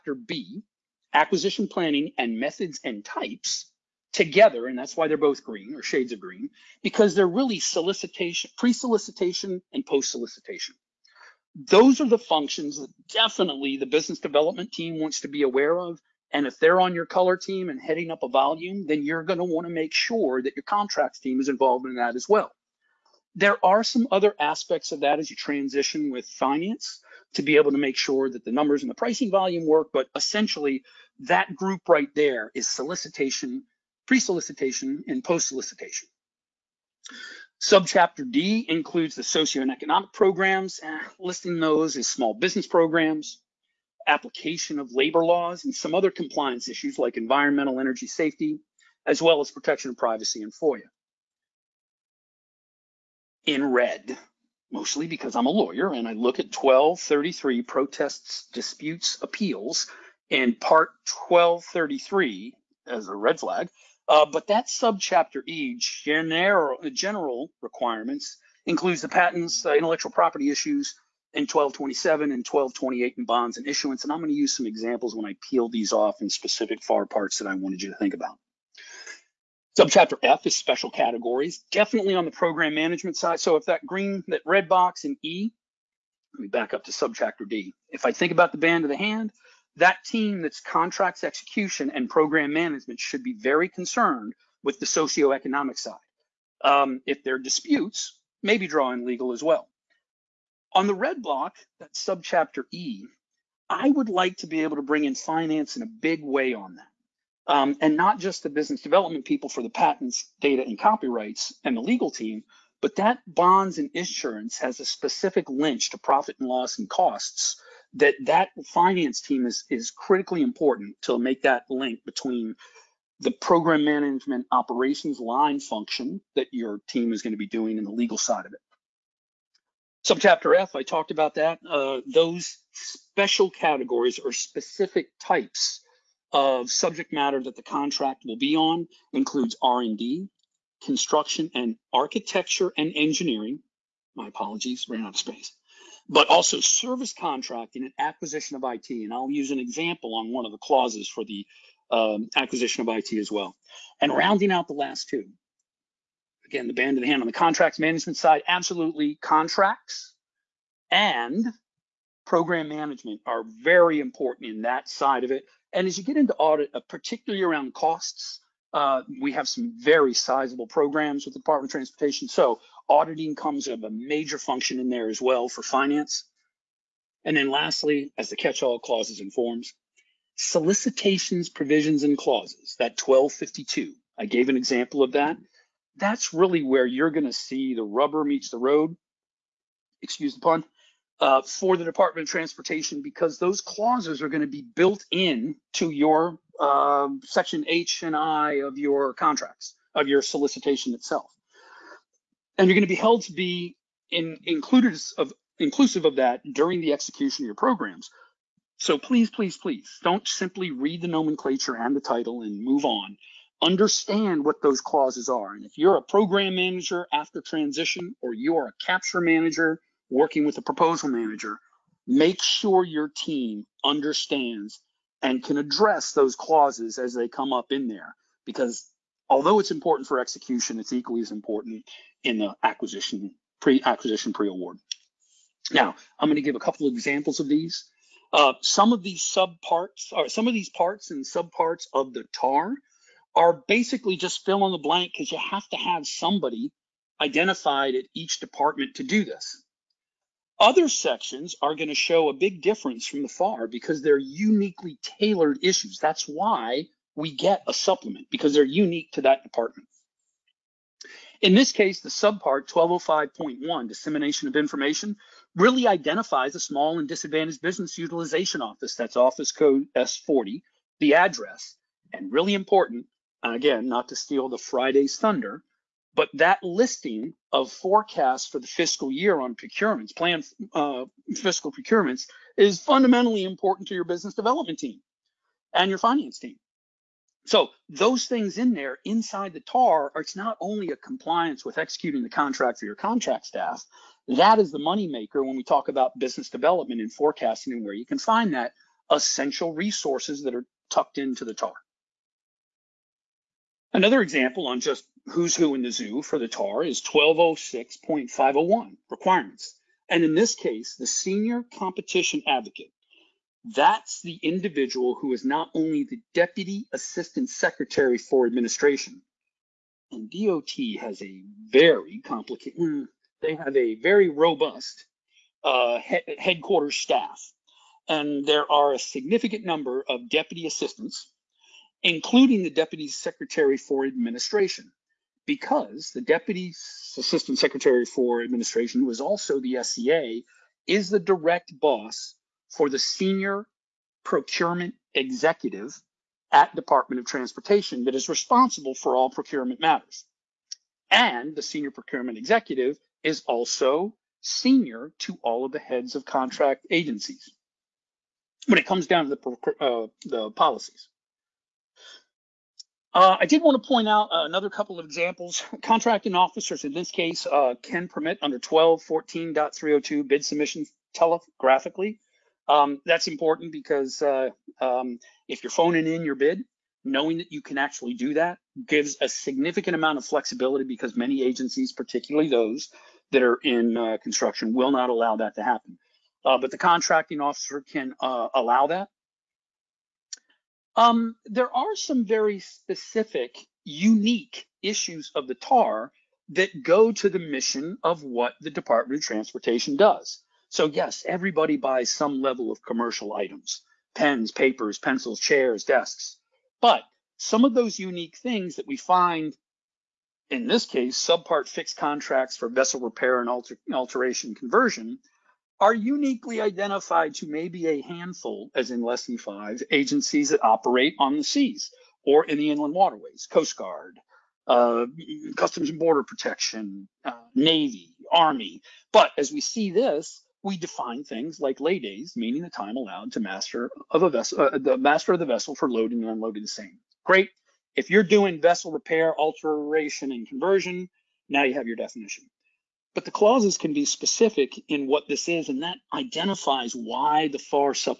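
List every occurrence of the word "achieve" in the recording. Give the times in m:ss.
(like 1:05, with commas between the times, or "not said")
not said.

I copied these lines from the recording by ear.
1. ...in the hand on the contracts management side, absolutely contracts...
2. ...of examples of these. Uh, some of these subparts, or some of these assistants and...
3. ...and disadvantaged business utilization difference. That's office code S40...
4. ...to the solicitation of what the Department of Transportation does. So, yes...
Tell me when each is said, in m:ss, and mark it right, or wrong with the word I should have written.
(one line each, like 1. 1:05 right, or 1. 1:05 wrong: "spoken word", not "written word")
1. 2:36 right
2. 3:56 wrong: "parts", not "assistants"
3. 4:26 wrong: "office", not "difference"
4. 6:37 wrong: "mission", not "solicitation".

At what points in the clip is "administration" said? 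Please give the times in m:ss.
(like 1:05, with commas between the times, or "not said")
5:18, 5:34, 5:38.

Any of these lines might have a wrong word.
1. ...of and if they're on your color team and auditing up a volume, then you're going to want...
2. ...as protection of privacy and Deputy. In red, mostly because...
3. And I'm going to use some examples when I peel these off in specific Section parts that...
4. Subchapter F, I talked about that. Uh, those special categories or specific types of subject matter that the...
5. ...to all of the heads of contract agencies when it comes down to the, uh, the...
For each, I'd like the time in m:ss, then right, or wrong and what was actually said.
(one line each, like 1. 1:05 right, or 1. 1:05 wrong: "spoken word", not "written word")
1. 0:15 wrong: "heading", not "auditing"
2. 0:49 wrong: "FOIA", not "Deputy"
3. 1:14 wrong: "FAR", not "Section"
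4. 2:10 right
5. 5:55 right.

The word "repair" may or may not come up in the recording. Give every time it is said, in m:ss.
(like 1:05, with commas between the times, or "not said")
6:52, 7:18.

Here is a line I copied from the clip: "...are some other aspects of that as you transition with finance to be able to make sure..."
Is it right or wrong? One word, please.
right.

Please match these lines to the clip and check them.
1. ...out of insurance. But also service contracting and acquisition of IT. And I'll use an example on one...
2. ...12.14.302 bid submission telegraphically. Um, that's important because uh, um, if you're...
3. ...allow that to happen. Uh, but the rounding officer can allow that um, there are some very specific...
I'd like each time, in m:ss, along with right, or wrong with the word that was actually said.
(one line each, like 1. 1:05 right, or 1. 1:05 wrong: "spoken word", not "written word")
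1. 2:25 wrong: "space", not "insurance"
2. 6:08 right
3. 6:25 wrong: "contracting", not "rounding".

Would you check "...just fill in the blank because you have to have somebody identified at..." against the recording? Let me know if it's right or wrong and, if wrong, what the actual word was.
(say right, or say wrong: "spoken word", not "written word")
right.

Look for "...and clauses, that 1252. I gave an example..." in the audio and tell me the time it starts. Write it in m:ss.
3:02.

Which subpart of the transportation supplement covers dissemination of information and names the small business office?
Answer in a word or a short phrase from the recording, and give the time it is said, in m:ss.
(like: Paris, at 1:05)
1205.1, at 4:22.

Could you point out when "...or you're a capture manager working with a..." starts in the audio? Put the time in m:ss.
3:38.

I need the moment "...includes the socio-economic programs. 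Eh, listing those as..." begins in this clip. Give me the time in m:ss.
0:38.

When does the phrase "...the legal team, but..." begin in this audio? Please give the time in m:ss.
1:51.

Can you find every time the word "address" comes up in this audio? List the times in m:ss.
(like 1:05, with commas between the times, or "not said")
3:45, 4:31.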